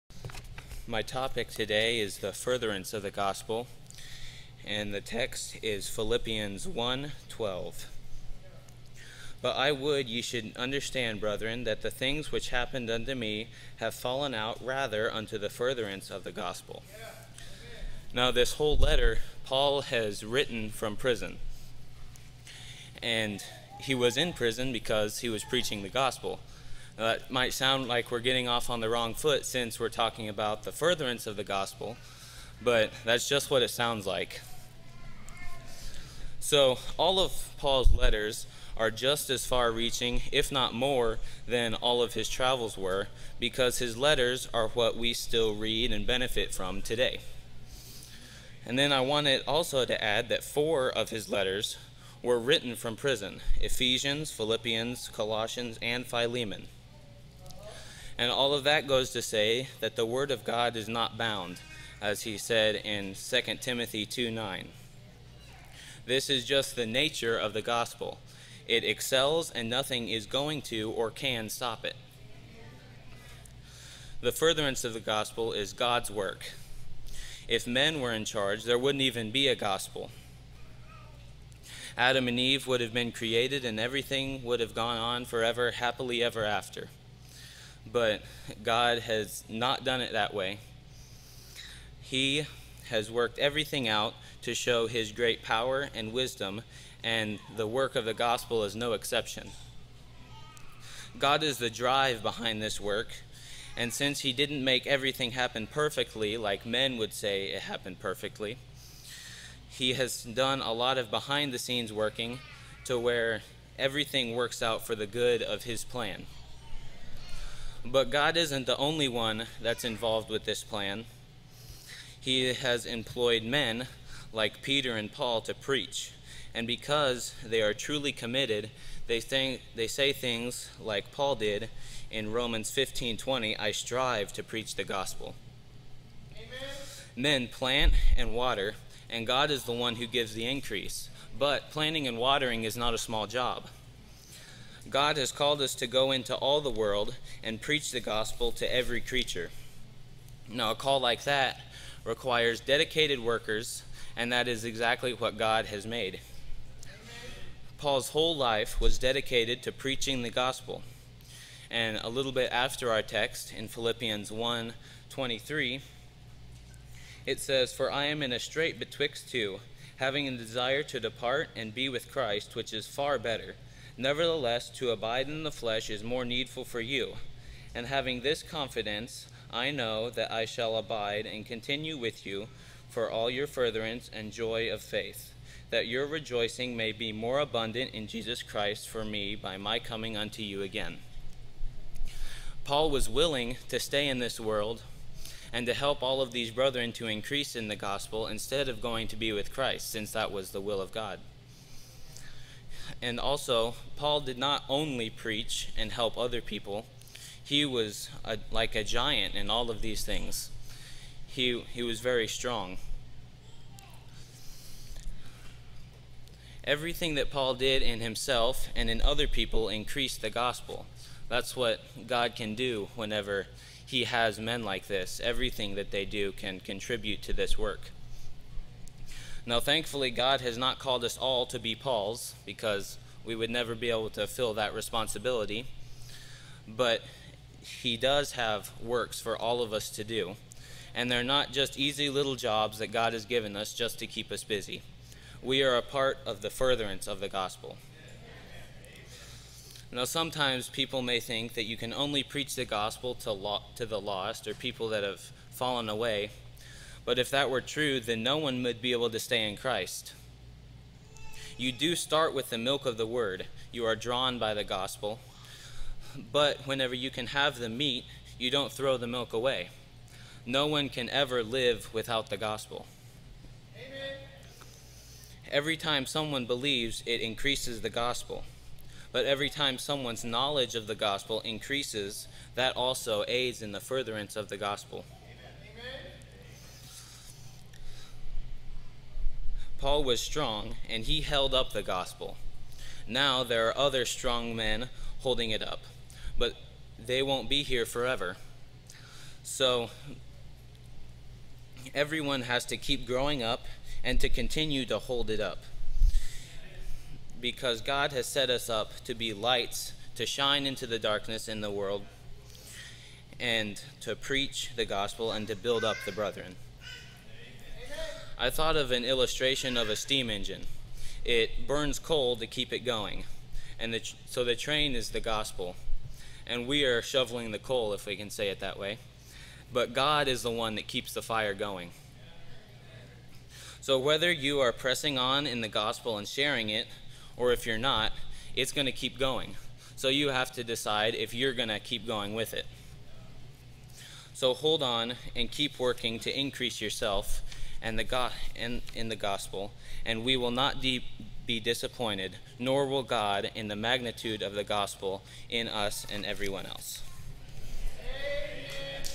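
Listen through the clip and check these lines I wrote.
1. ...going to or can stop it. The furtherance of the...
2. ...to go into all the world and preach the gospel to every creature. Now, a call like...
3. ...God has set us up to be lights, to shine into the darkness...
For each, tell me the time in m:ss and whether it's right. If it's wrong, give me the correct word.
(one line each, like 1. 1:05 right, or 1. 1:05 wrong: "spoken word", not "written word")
1. 1:10 right
2. 2:25 right
3. 5:07 right.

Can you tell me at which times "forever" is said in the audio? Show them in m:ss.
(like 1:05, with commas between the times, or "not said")
1:25, 4:57.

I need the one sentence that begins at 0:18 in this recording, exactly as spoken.
Now, this whole letter Paul has written from prison.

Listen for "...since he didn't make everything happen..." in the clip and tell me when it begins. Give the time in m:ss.
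1:43.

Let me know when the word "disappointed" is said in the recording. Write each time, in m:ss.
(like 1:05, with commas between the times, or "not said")
5:51.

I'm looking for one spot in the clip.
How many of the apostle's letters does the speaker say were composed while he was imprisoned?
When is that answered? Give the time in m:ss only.
0:50.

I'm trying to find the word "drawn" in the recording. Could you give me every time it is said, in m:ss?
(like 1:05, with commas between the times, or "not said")
4:23.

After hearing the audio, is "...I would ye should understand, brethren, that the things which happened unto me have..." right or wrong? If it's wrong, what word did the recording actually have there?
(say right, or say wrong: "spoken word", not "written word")
right.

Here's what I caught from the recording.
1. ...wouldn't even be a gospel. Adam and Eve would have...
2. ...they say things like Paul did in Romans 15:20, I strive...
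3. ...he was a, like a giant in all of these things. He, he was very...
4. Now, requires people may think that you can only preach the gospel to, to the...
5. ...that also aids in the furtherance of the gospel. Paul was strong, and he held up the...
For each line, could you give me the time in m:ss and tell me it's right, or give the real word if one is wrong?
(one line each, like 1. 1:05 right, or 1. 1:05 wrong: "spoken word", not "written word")
1. 1:18 right
2. 2:09 right
3. 3:27 right
4. 4:09 wrong: "sometimes", not "requires"
5. 4:42 right.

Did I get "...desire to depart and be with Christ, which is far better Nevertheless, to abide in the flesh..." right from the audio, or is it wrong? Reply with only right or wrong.
right.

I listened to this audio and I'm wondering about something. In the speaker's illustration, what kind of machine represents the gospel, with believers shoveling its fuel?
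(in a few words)
steam engine.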